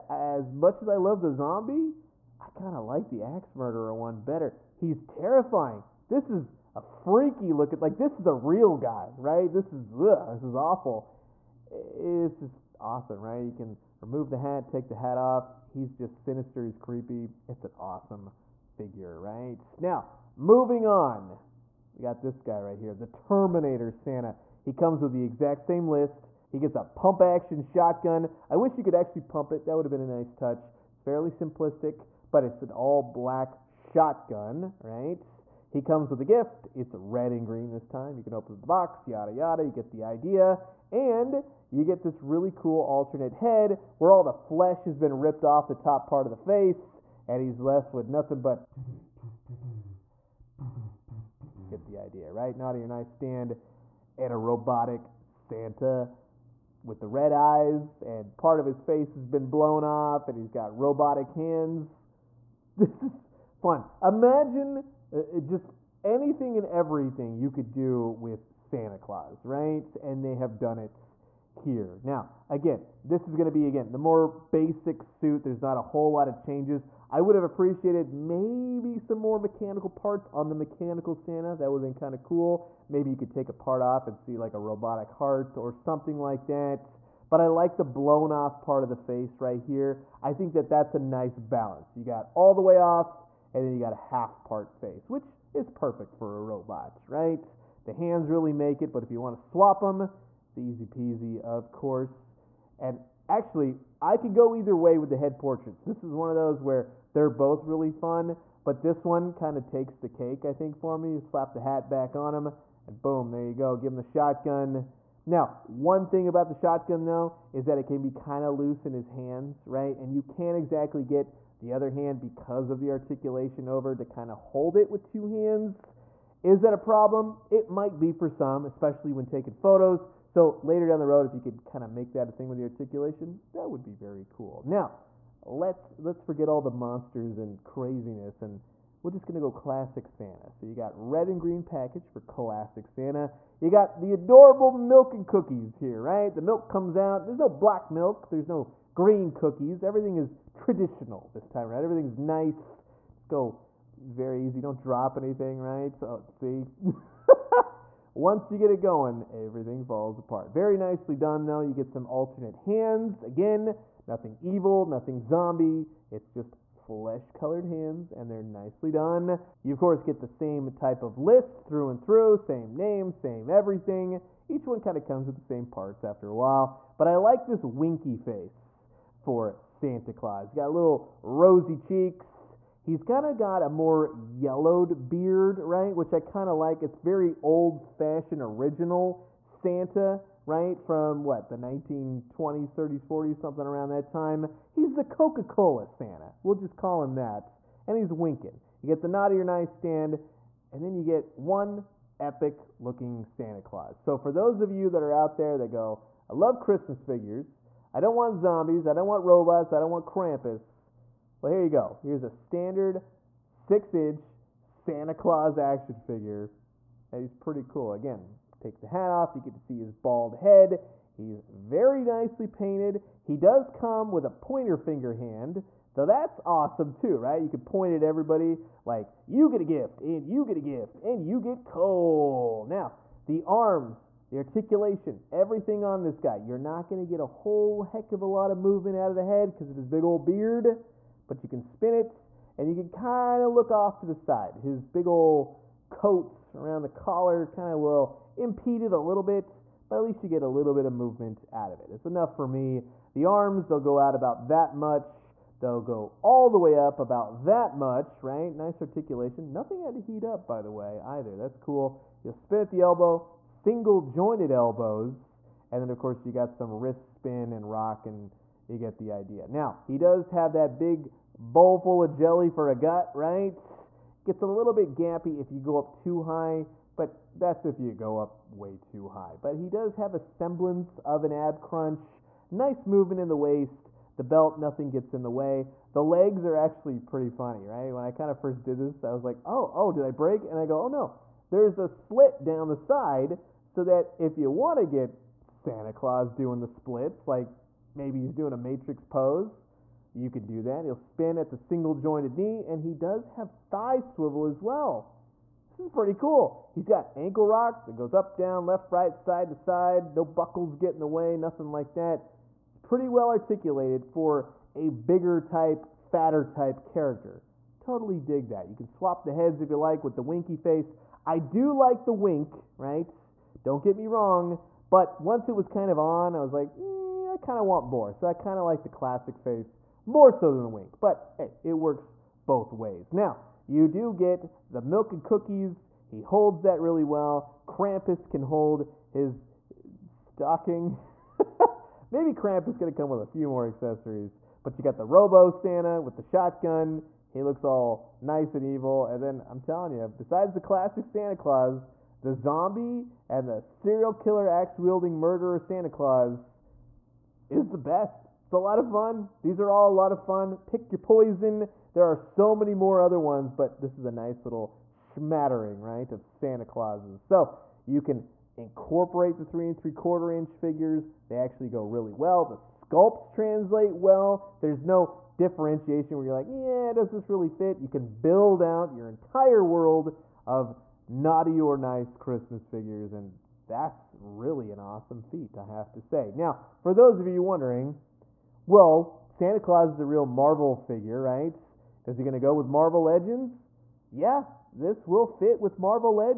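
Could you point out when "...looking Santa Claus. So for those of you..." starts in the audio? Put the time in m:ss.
3:22.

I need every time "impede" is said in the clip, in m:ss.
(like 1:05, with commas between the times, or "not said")
4:08.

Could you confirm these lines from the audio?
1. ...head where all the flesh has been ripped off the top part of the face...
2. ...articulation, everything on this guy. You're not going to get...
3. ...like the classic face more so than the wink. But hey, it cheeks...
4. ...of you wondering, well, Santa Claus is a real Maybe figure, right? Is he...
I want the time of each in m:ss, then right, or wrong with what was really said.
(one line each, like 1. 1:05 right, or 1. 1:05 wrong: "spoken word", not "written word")
1. 0:43 right
2. 3:54 right
3. 5:28 wrong: "works", not "cheeks"
4. 6:27 wrong: "Marvel", not "Maybe".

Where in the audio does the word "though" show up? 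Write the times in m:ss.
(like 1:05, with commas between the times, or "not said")
1:57, 2:41, 3:45.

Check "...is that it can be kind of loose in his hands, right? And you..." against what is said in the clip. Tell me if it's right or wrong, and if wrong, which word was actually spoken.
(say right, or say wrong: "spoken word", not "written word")
right.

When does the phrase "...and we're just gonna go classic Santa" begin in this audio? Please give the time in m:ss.
2:18.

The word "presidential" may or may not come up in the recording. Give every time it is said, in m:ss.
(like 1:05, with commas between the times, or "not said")
not said.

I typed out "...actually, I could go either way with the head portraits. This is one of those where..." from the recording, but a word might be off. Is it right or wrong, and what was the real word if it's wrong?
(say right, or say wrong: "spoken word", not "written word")
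right.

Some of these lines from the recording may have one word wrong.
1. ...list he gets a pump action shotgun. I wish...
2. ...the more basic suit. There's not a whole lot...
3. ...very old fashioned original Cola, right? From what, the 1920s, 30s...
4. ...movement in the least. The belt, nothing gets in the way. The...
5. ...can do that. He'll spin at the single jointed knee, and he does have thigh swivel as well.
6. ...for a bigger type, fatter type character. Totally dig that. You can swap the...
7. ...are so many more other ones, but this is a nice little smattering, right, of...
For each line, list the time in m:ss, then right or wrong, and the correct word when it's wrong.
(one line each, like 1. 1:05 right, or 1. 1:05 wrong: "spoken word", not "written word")
1. 0:25 right
2. 1:13 right
3. 3:06 wrong: "Santa", not "Cola"
4. 4:42 wrong: "waist", not "least"
5. 5:00 right
6. 5:14 right
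7. 6:02 right.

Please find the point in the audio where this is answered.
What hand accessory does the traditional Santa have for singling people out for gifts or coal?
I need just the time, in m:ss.
3:44.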